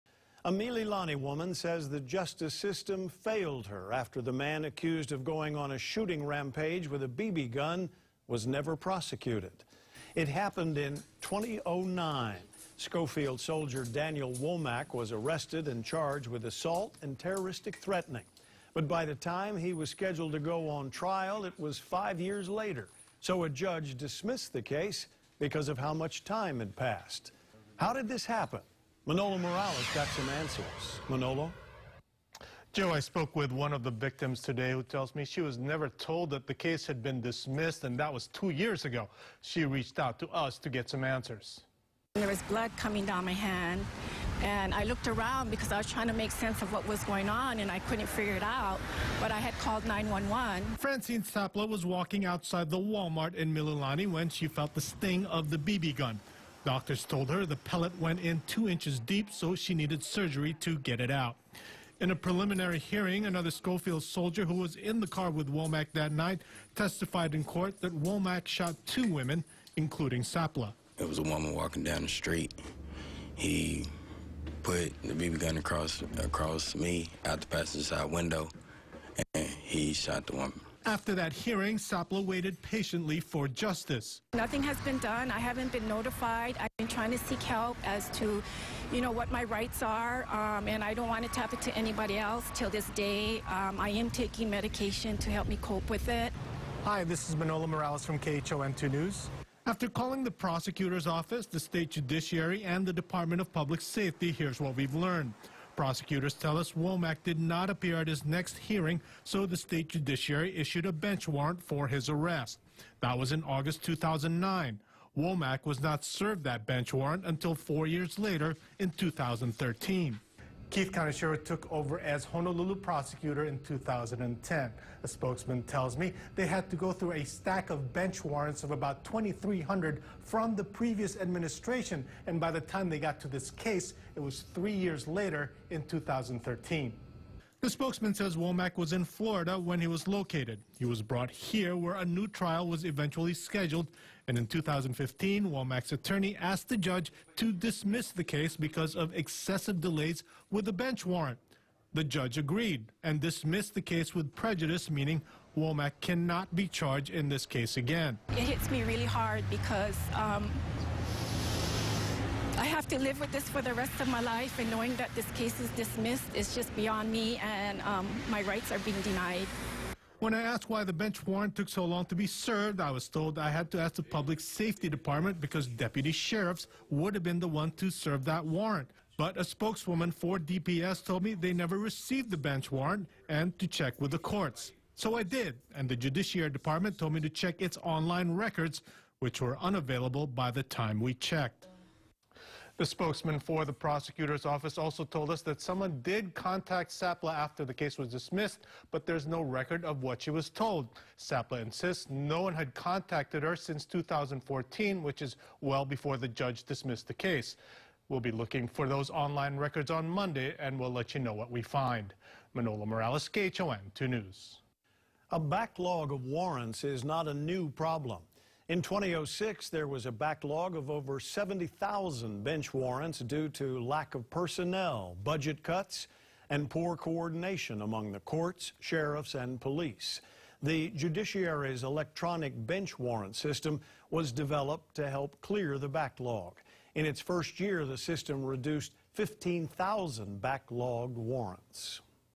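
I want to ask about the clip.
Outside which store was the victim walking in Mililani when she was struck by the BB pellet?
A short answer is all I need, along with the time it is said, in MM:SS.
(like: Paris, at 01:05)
Walmart, at 00:52.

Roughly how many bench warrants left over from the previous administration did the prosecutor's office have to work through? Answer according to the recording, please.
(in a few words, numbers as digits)
2,300.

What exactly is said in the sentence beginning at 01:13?
He put the BB gun across across me out the passenger side window, and he shot the woman.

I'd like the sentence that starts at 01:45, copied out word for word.
Prosecutors tell us Womack did not appear at his next hearing, so the state judiciary issued a bench warrant for his arrest.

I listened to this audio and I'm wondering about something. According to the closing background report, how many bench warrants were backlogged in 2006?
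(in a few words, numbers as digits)
70,000.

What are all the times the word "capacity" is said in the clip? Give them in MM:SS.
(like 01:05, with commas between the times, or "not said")
not said.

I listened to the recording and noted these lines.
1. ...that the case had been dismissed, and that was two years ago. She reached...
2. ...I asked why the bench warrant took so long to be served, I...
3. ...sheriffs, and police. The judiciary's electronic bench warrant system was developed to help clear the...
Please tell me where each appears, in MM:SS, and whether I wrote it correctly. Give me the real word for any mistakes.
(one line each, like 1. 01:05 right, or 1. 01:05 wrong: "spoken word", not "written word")
1. 00:36 right
2. 02:50 right
3. 03:48 right.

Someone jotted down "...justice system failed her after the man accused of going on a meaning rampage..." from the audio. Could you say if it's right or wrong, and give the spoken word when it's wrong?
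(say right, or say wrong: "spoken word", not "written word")
wrong: "shooting", not "meaning".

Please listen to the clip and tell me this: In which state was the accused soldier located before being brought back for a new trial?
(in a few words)
Florida.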